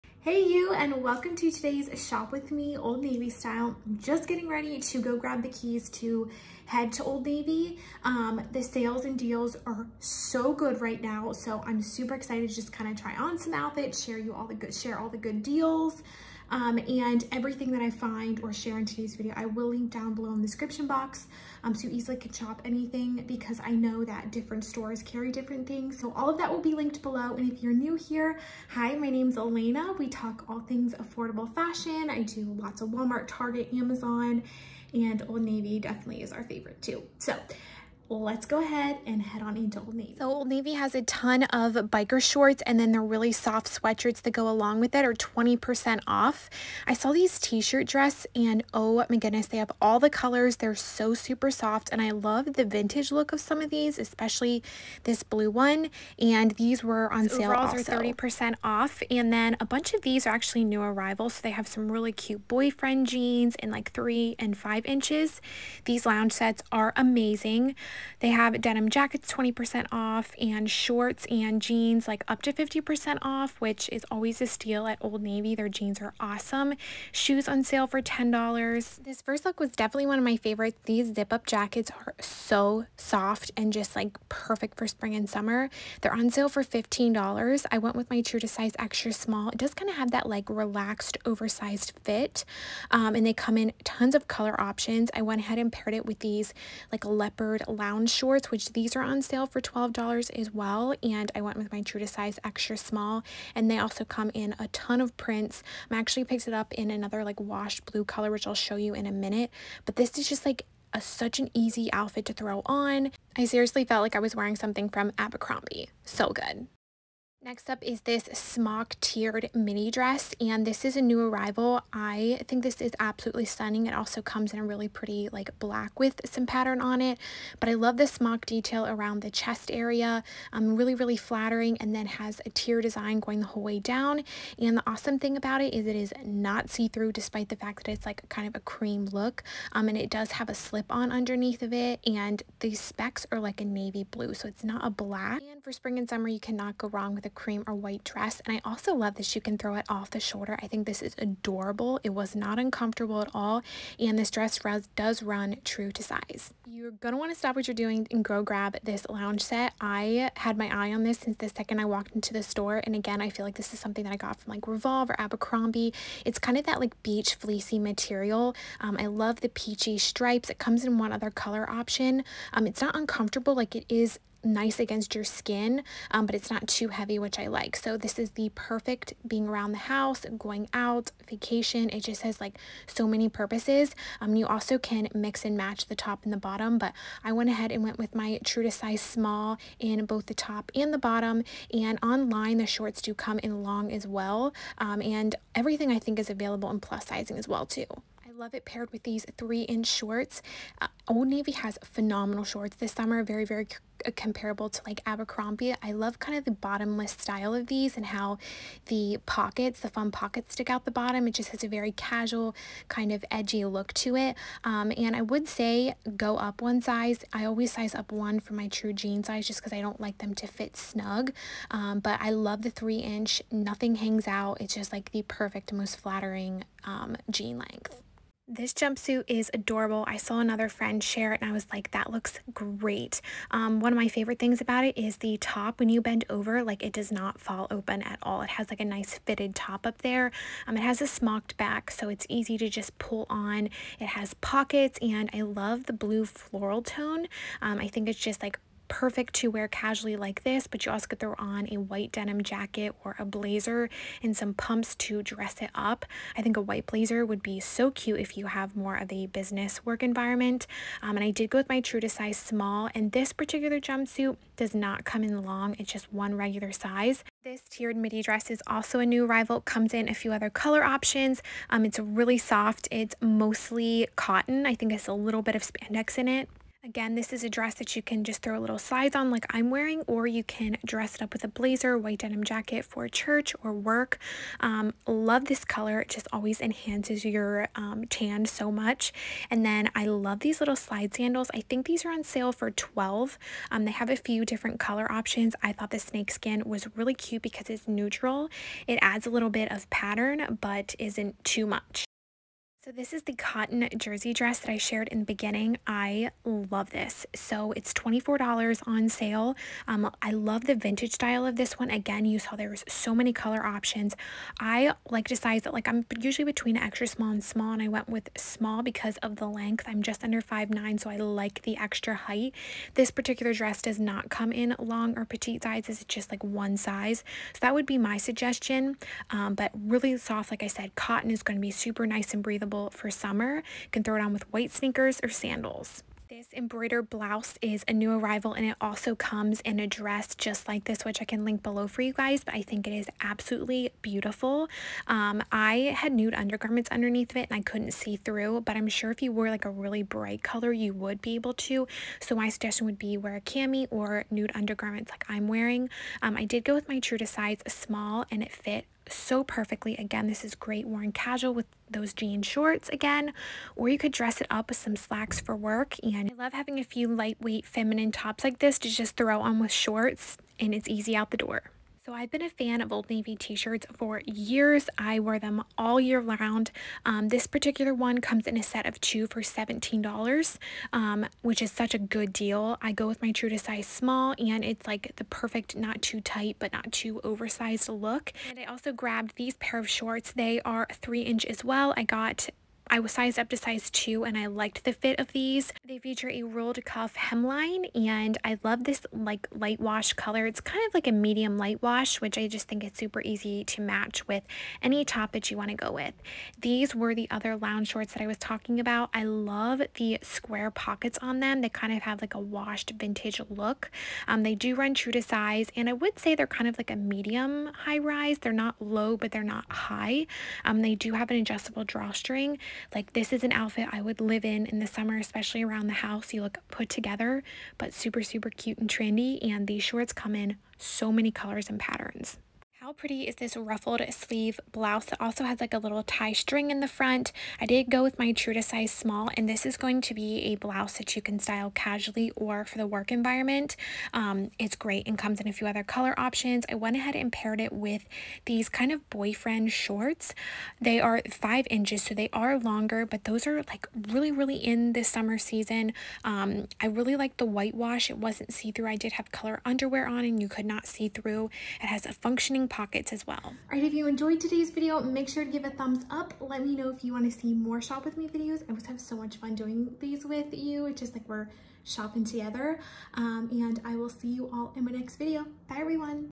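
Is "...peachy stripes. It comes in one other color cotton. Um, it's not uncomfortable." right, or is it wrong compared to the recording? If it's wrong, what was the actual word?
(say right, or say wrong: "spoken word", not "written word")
wrong: "option", not "cotton".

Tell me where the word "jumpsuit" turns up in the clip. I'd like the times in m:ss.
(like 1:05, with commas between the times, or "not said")
3:48, 4:23.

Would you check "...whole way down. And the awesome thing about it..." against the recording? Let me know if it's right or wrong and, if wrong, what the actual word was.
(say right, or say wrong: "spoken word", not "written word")
right.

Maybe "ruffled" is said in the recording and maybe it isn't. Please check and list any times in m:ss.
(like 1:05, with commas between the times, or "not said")
7:13.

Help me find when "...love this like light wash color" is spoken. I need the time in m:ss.
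6:38.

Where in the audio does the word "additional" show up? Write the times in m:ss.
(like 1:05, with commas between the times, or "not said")
not said.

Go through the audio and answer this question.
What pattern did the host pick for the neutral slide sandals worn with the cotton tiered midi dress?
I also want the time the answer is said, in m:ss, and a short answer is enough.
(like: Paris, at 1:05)
snakeskin, at 4:55.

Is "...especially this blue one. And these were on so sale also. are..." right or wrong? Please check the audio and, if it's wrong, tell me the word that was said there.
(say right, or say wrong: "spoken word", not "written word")
right.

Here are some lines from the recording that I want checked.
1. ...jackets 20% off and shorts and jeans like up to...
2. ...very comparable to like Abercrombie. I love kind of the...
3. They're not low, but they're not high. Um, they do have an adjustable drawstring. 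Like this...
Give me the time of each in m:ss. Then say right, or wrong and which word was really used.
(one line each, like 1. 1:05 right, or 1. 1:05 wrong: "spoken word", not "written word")
1. 1:08 right
2. 3:23 right
3. 6:58 right.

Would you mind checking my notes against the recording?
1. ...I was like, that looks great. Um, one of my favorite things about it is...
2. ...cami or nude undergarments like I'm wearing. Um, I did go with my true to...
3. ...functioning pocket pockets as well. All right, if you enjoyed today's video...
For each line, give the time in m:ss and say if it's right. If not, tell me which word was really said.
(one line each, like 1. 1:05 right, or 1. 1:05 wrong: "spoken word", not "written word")
1. 3:51 right
2. 5:53 right
3. 7:42 right.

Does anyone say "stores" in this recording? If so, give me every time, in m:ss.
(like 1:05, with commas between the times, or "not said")
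0:24, 2:42.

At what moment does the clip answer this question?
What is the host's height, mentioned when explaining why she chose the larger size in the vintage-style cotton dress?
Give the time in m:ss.
5:20.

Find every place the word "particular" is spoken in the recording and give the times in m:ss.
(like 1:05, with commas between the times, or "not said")
4:23, 5:23, 6:17.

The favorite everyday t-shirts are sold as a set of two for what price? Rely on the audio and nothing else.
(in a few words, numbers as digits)
$17.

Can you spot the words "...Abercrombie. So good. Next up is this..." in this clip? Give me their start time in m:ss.
1:55.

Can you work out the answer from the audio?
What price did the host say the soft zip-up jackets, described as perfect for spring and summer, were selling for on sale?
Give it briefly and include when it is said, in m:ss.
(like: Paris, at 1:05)
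$15, at 1:26.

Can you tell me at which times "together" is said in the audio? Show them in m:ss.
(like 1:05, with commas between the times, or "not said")
7:06, 7:52.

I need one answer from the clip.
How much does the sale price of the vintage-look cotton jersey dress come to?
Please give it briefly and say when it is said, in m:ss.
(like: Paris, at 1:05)
$24, at 5:07.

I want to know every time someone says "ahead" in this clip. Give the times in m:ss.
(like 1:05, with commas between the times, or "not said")
0:38, 1:35, 3:07, 7:26.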